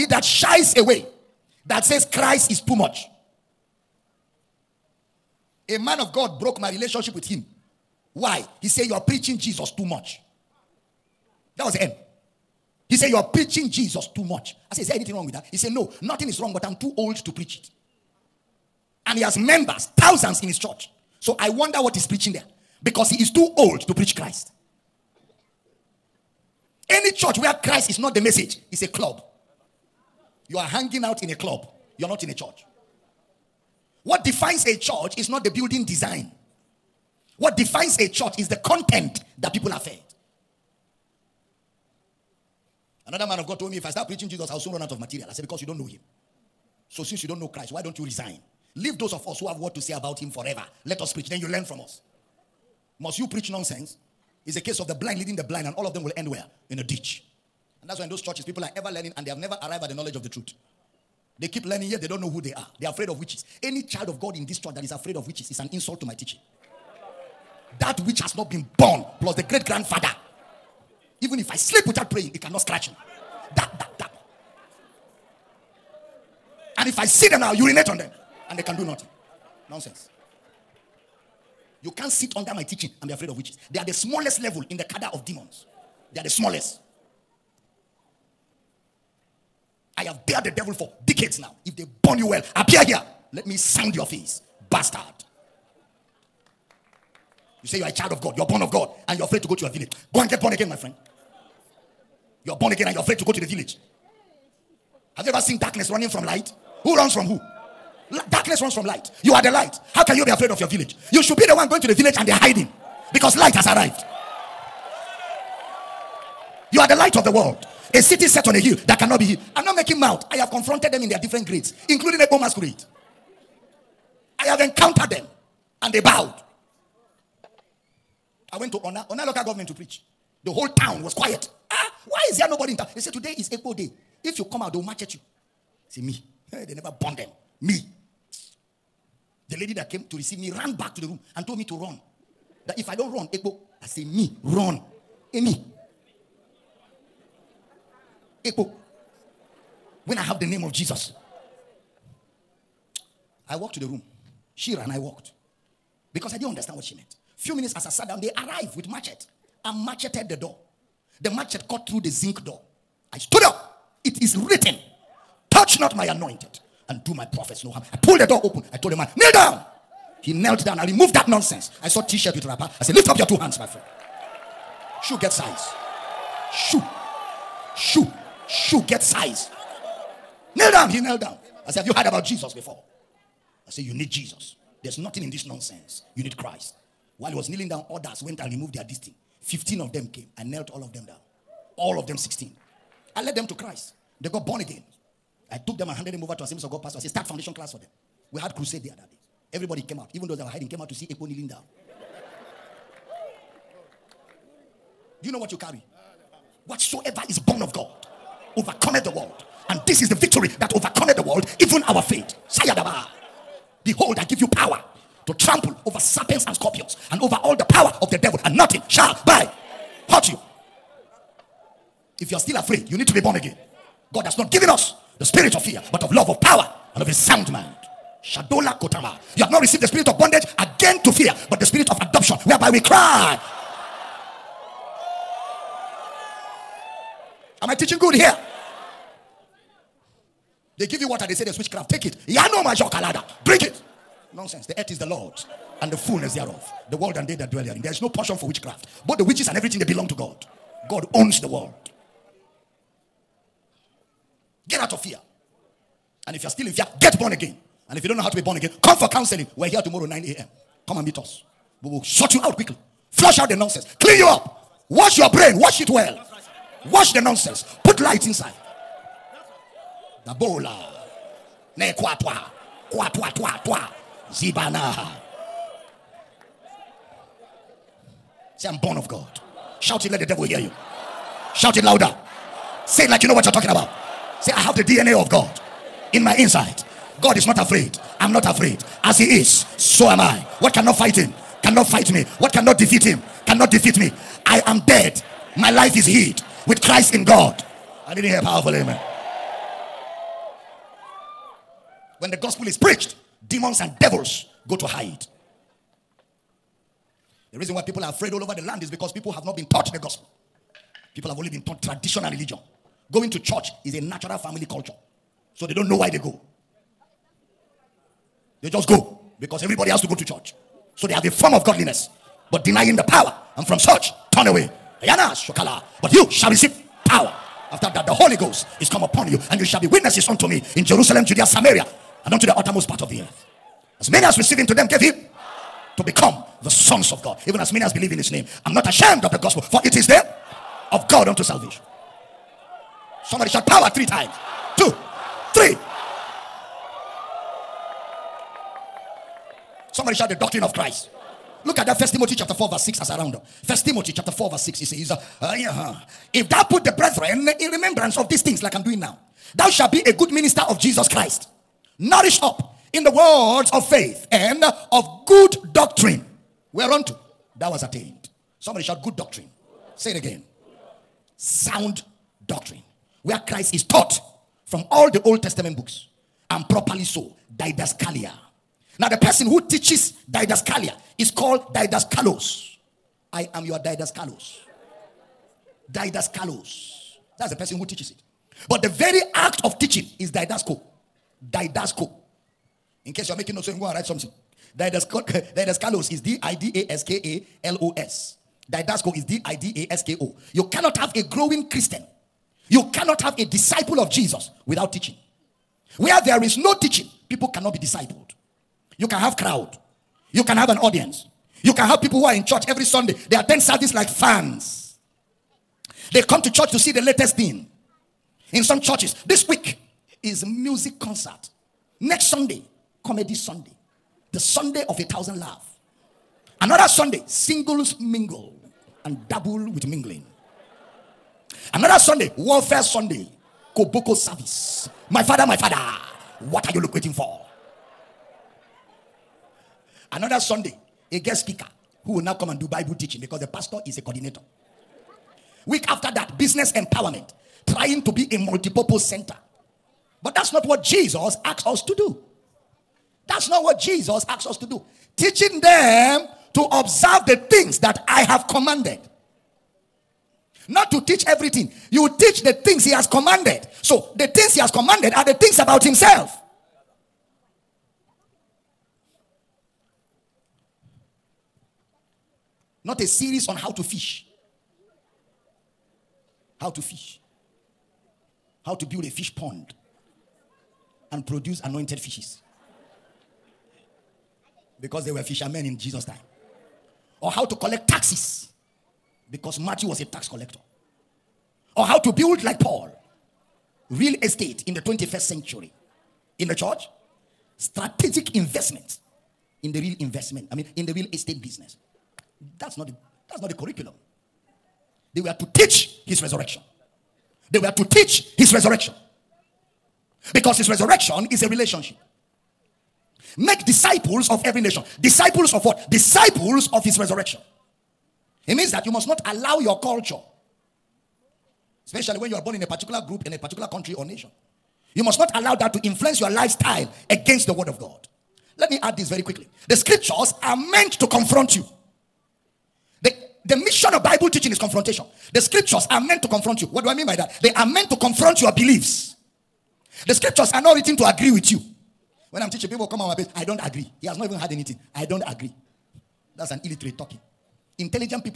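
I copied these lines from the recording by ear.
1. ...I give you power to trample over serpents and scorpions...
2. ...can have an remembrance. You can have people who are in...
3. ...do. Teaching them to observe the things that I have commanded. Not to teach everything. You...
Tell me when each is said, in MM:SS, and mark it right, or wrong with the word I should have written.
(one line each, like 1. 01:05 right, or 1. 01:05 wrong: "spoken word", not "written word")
1. 03:34 right
2. 06:50 wrong: "audience", not "remembrance"
3. 07:34 right.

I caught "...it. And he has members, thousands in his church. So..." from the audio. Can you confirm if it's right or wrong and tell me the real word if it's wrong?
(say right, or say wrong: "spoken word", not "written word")
right.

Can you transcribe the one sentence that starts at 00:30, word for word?
You are hanging out in a club.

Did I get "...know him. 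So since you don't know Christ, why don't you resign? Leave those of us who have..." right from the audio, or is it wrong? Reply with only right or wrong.
right.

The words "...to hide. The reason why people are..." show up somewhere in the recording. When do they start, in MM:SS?
05:04.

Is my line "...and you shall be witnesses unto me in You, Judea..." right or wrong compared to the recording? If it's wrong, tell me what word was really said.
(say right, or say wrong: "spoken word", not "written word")
wrong: "Jerusalem", not "You".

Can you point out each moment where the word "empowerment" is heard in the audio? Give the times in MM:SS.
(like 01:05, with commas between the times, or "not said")
07:26.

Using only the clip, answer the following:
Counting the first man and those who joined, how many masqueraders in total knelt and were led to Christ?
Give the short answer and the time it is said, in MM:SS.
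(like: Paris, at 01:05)
16, at 03:11.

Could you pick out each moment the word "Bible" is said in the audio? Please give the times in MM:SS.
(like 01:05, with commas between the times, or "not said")
07:22, 08:54.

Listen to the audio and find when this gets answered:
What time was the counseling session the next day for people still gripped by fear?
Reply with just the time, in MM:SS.
04:20.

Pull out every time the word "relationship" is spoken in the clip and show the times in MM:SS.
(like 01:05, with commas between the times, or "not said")
00:06, 08:31.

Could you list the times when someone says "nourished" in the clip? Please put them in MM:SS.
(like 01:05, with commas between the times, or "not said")
06:01.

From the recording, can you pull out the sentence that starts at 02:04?
I have encountered them and they bowed.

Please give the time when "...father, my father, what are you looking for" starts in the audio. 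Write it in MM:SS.
07:15.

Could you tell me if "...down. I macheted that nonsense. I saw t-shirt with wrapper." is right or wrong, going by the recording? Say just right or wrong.
wrong.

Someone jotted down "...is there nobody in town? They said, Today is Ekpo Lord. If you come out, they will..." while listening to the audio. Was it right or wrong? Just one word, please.
wrong.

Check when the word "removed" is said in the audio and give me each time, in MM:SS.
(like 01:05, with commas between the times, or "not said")
02:50, 03:08.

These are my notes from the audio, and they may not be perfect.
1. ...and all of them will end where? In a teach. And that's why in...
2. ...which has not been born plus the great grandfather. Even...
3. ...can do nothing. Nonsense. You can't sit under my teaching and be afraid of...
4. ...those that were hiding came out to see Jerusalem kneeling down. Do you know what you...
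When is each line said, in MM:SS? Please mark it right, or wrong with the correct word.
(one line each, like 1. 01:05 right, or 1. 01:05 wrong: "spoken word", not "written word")
1. 00:55 wrong: "ditch", not "teach"
2. 01:08 right
3. 01:18 right
4. 03:20 wrong: "Ekpo", not "Jerusalem".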